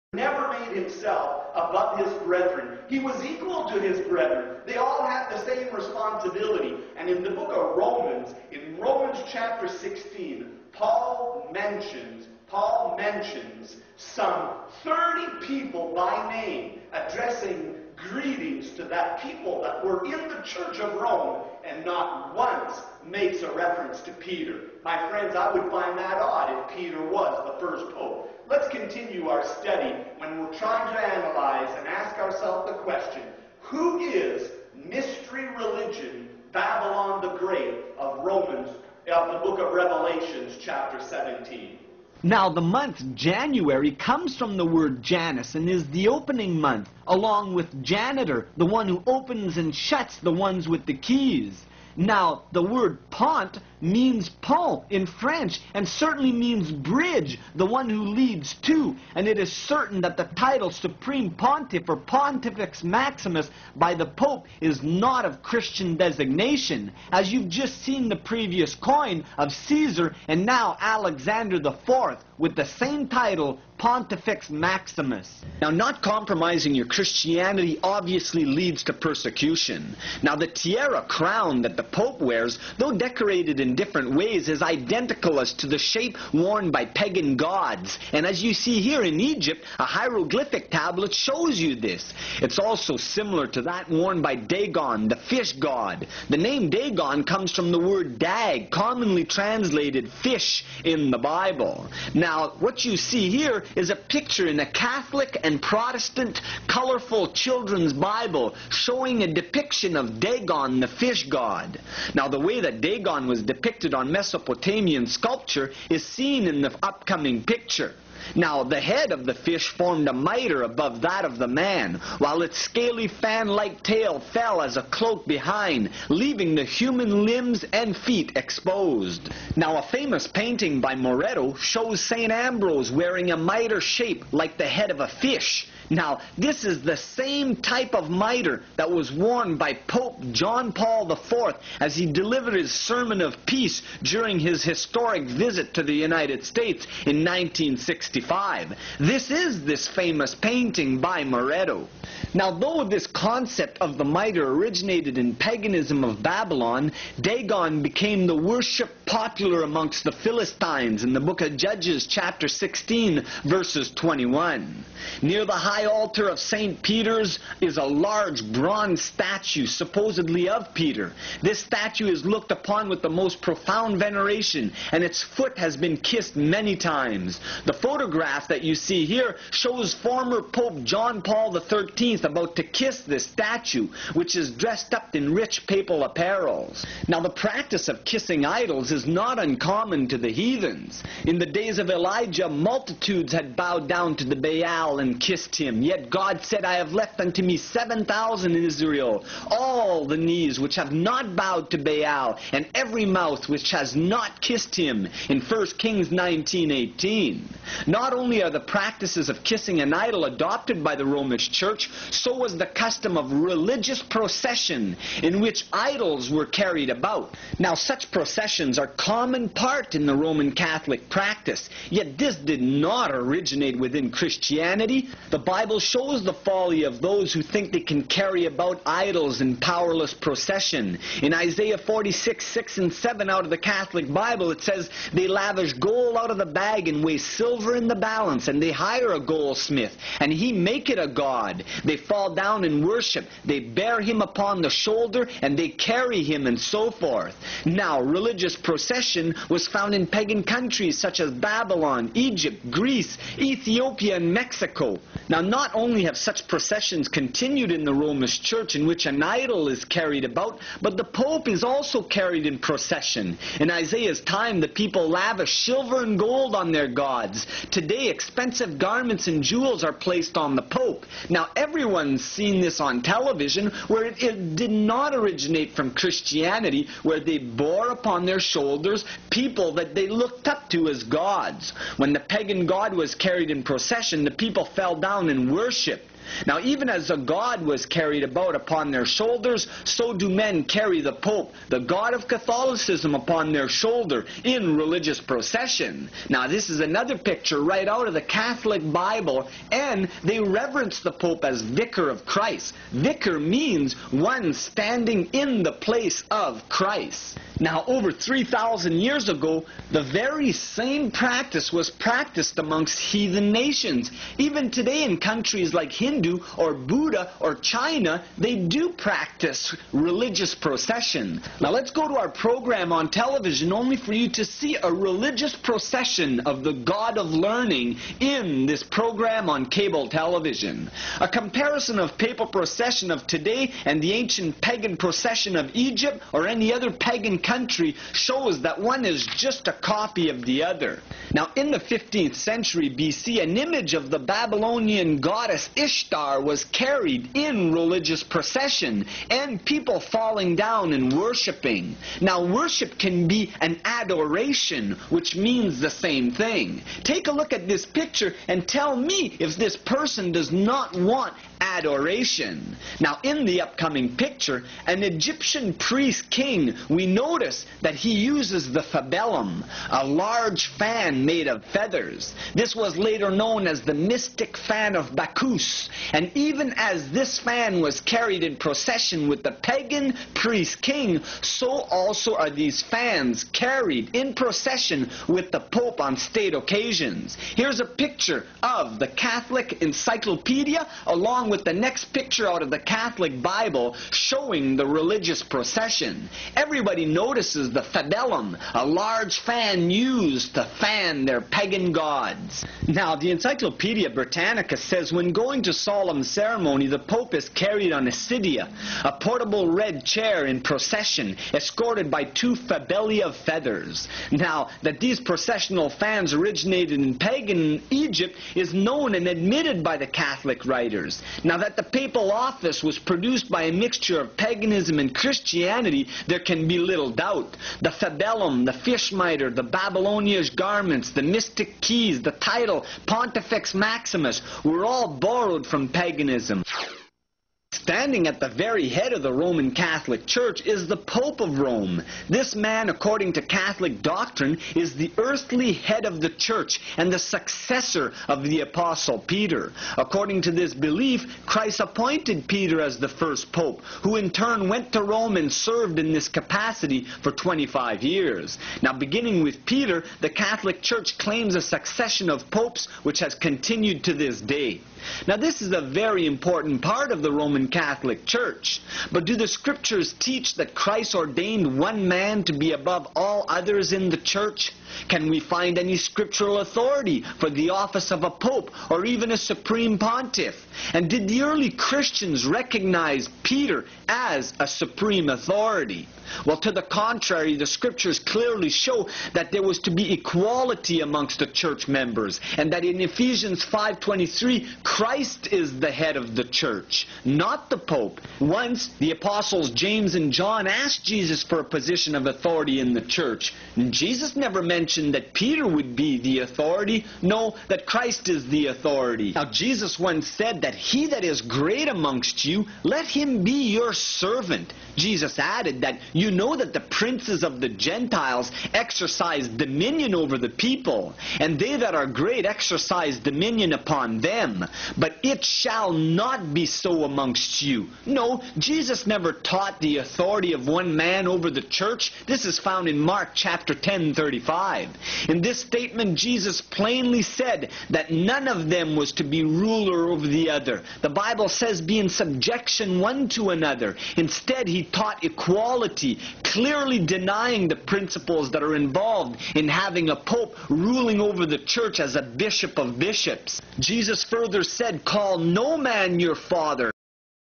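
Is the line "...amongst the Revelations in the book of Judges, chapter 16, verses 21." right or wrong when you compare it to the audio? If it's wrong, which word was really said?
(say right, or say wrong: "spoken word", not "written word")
wrong: "Philistines", not "Revelations".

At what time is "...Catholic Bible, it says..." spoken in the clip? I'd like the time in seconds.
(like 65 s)
233 s.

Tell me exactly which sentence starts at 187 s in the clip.
Now, the practice of kissing idols is not uncommon to the heathens.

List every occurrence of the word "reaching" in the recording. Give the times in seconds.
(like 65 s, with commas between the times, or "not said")
not said.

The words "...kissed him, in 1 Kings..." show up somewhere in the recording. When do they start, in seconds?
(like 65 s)
204 s.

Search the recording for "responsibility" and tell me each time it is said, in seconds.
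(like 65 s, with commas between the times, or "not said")
5 s.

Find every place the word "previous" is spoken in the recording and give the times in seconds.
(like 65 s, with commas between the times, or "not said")
68 s.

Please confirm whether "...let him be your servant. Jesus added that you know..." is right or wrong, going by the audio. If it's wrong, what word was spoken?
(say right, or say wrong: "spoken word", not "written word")
right.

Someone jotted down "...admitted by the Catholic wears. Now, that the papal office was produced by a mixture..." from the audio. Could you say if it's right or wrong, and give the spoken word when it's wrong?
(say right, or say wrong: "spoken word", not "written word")
wrong: "writers", not "wears".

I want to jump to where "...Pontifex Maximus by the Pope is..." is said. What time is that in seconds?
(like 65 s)
61 s.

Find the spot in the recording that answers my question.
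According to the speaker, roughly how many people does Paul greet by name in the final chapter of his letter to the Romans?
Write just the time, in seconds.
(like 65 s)
13 s.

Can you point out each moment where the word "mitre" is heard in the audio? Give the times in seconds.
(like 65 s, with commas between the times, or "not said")
120 s, 133 s, 138 s, 154 s, 429 s.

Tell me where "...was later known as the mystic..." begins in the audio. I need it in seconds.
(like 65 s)
372 s.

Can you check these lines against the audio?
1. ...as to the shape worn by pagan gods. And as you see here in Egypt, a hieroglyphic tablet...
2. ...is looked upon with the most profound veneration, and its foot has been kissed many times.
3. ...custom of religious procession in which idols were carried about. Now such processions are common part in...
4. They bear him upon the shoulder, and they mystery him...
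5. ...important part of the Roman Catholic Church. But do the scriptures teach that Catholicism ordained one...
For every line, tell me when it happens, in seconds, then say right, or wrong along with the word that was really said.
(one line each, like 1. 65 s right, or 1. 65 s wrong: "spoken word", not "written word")
1. 85 s right
2. 172 s right
3. 212 s right
4. 243 s wrong: "carry", not "mystery"
5. 466 s wrong: "Christ", not "Catholicism".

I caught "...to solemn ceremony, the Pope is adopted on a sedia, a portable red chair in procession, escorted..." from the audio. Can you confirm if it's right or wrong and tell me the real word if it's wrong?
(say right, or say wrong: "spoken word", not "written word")
wrong: "carried", not "adopted".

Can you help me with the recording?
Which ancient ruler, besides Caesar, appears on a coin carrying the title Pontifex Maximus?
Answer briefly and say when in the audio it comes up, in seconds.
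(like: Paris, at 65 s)
Alexander the Fourth, at 70 s.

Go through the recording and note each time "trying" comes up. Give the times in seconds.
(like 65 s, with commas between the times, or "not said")
30 s.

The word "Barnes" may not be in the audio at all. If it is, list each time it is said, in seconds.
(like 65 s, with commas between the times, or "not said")
not said.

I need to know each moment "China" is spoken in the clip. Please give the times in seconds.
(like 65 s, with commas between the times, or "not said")
317 s.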